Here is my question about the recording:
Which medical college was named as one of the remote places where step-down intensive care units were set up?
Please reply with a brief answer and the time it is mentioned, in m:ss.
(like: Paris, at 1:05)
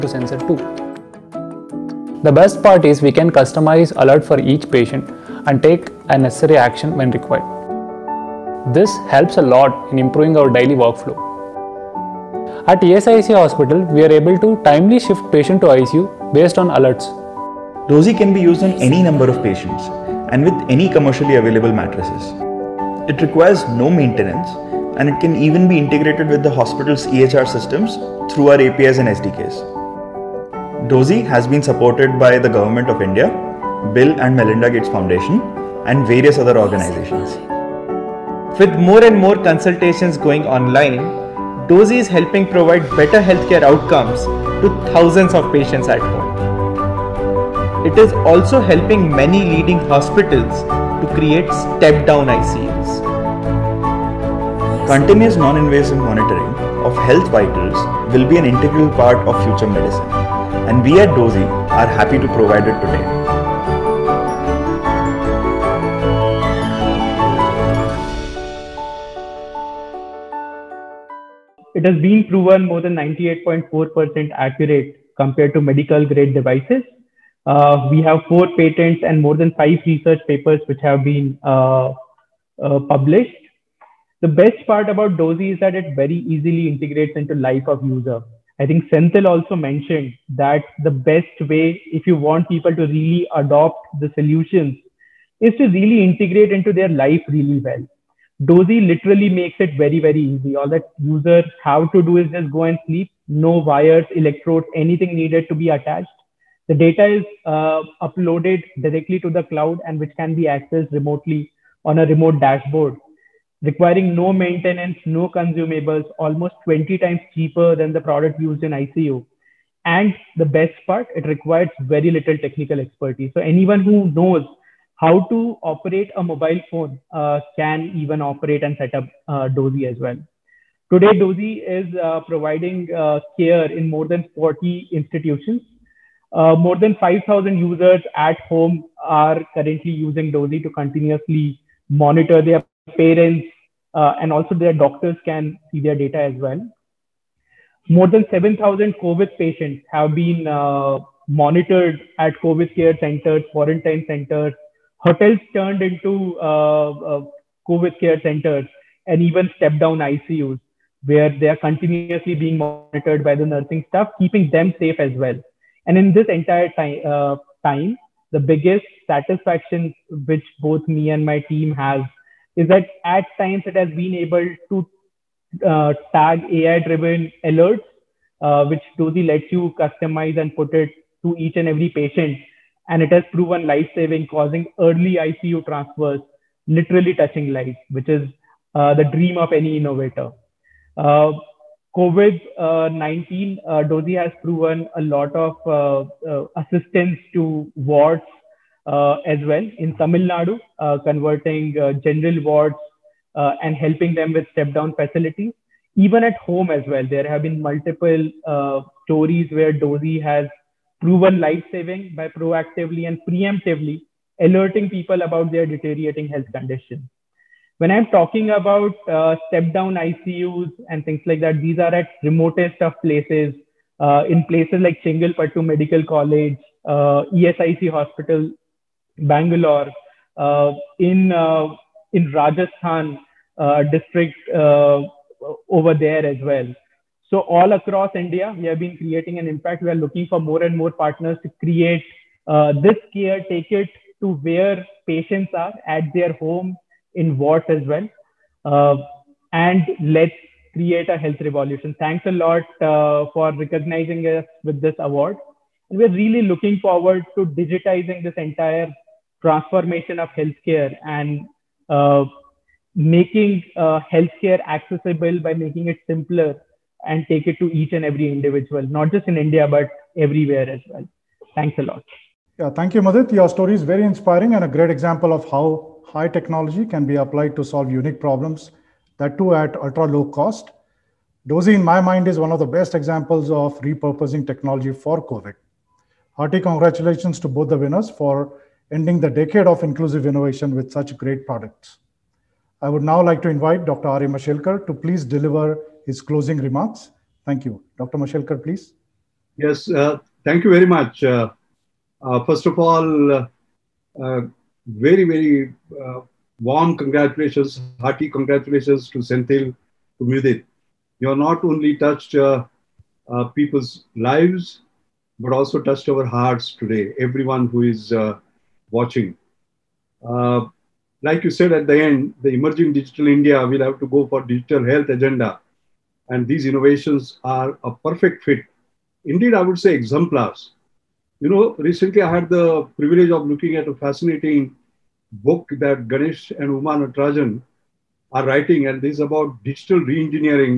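Chengalpattu Medical College, at 3:45.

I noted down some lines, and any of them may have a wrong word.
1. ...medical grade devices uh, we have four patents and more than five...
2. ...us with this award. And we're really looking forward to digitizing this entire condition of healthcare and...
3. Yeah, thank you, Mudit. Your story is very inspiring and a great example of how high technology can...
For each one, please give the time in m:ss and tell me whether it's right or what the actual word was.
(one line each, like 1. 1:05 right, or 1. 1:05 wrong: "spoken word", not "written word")
1. 1:15 right
2. 4:14 wrong: "transformation", not "condition"
3. 4:32 right.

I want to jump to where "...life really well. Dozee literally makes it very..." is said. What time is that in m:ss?
1:36.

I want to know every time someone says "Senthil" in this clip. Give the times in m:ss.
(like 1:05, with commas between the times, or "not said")
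1:28, 5:09.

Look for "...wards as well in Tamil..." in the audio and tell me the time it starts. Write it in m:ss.
3:17.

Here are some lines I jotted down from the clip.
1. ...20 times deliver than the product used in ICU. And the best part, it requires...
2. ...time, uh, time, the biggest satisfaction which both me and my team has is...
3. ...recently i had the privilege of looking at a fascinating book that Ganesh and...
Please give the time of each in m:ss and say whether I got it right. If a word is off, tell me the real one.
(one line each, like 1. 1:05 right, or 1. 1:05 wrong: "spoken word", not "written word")
1. 1:56 wrong: "cheaper", not "deliver"
2. 2:46 right
3. 5:31 right.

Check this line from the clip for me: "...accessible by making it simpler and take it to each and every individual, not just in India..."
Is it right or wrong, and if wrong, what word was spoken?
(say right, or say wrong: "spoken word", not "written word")
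right.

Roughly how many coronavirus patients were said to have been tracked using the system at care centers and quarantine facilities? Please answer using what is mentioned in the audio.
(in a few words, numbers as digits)
More than 7,000.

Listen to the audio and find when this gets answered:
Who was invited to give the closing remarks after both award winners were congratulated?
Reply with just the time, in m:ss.
4:53.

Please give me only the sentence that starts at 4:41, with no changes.
Dozee, in my mind, is one of the best examples of repurposing technology for COVID.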